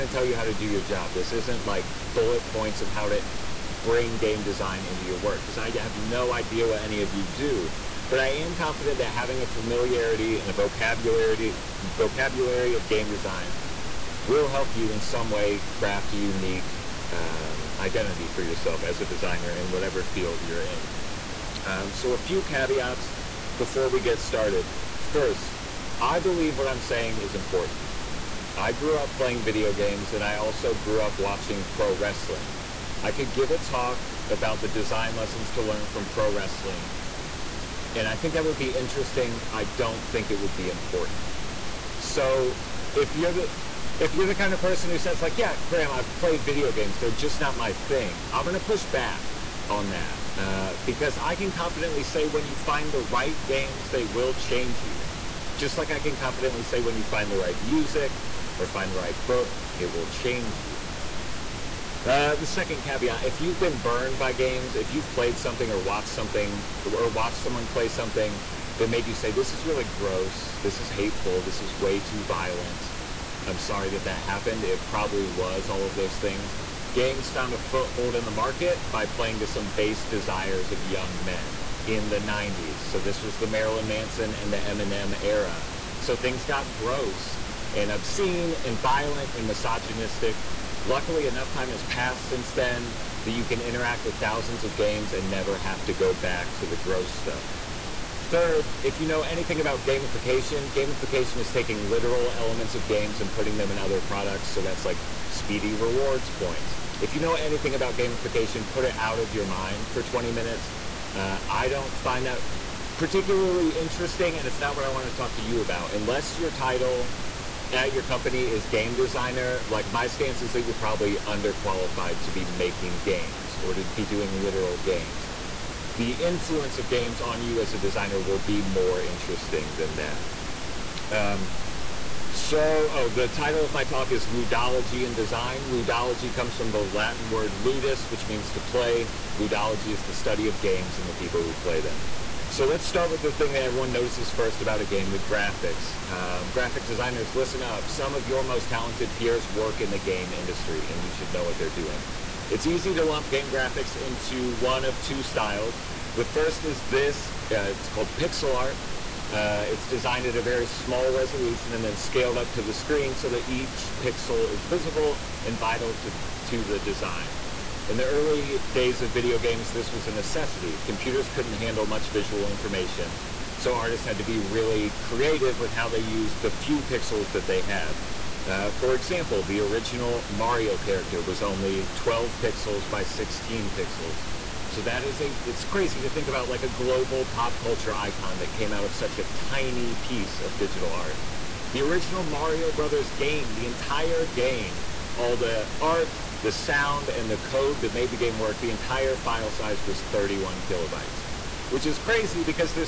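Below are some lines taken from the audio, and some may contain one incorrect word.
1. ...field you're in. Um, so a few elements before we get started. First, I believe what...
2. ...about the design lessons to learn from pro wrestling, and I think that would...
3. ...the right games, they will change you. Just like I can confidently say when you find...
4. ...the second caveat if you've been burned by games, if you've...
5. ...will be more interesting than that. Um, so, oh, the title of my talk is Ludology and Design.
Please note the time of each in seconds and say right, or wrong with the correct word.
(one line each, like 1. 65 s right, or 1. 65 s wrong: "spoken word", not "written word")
1. 20 s wrong: "caveats", not "elements"
2. 34 s right
3. 52 s right
4. 62 s right
5. 128 s right.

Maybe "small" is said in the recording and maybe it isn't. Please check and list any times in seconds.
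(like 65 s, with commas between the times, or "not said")
160 s.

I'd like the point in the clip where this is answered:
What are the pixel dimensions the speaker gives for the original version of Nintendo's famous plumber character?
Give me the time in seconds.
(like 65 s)
181 s.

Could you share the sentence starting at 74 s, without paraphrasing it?
It probably was all of those things.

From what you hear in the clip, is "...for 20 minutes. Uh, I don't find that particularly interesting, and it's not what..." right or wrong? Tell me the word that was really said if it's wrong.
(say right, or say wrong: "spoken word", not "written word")
right.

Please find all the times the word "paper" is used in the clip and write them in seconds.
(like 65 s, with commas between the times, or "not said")
not said.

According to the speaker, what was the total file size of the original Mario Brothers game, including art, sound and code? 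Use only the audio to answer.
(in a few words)
31 kilobytes.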